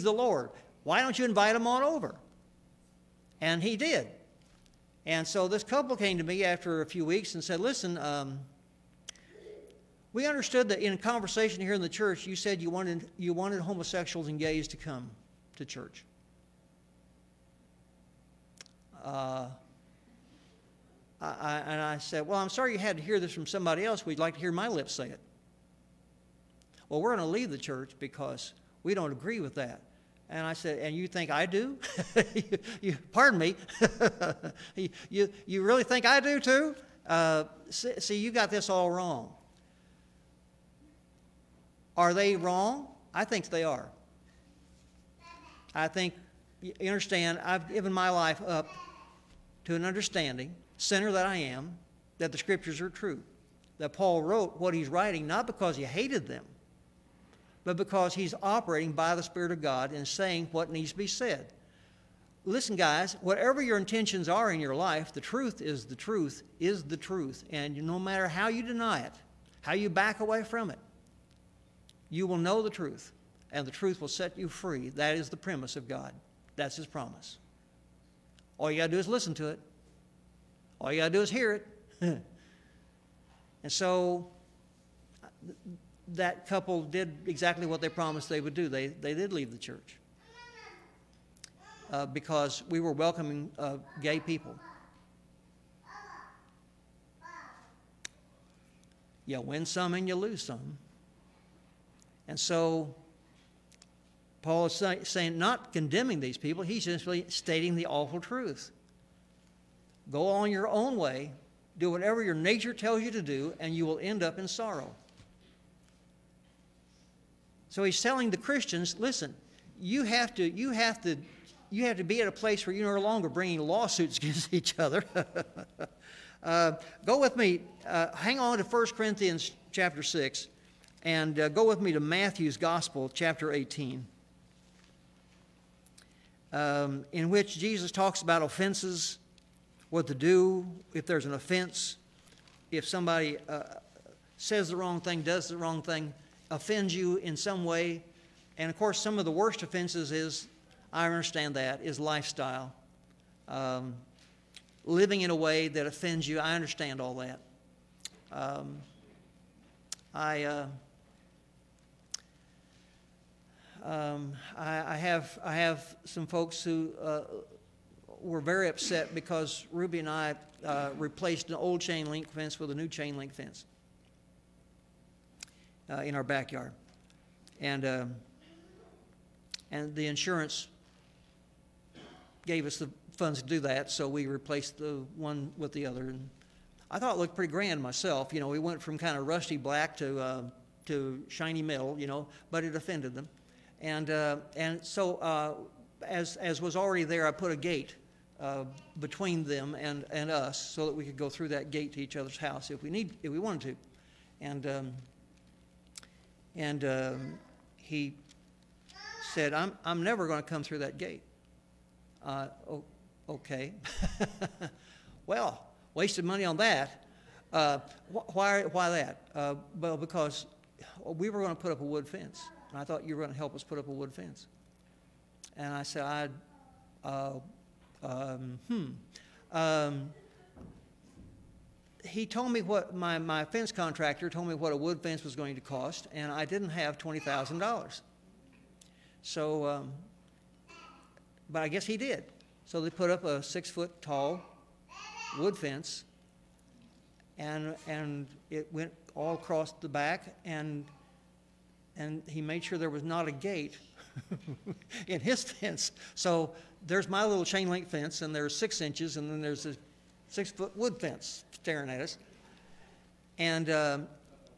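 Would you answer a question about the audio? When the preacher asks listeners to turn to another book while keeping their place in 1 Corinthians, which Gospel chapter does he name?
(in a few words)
Matthew 18.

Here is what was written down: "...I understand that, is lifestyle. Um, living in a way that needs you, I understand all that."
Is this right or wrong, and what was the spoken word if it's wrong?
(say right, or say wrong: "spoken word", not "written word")
wrong: "offends", not "needs".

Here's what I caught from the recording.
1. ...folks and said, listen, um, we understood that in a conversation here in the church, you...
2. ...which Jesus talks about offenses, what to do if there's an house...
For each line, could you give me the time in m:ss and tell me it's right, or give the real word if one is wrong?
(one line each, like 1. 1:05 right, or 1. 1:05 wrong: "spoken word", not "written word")
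1. 0:07 wrong: "weeks", not "folks"
2. 2:17 wrong: "offense", not "house".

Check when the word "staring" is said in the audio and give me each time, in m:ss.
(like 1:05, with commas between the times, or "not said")
4:21.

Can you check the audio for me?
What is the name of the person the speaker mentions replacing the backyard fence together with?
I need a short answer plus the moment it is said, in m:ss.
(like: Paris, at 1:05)
Ruby, at 2:49.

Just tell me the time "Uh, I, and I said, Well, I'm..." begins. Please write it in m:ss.
0:19.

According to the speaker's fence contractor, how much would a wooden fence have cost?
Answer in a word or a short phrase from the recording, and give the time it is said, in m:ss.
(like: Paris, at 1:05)
$20,000, at 3:56.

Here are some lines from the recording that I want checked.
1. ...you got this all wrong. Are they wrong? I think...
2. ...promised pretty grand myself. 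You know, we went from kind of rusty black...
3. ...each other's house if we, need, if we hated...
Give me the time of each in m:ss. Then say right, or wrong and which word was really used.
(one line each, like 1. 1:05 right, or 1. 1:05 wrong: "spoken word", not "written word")
1. 0:38 right
2. 3:07 wrong: "looked", not "promised"
3. 3:22 wrong: "wanted", not "hated".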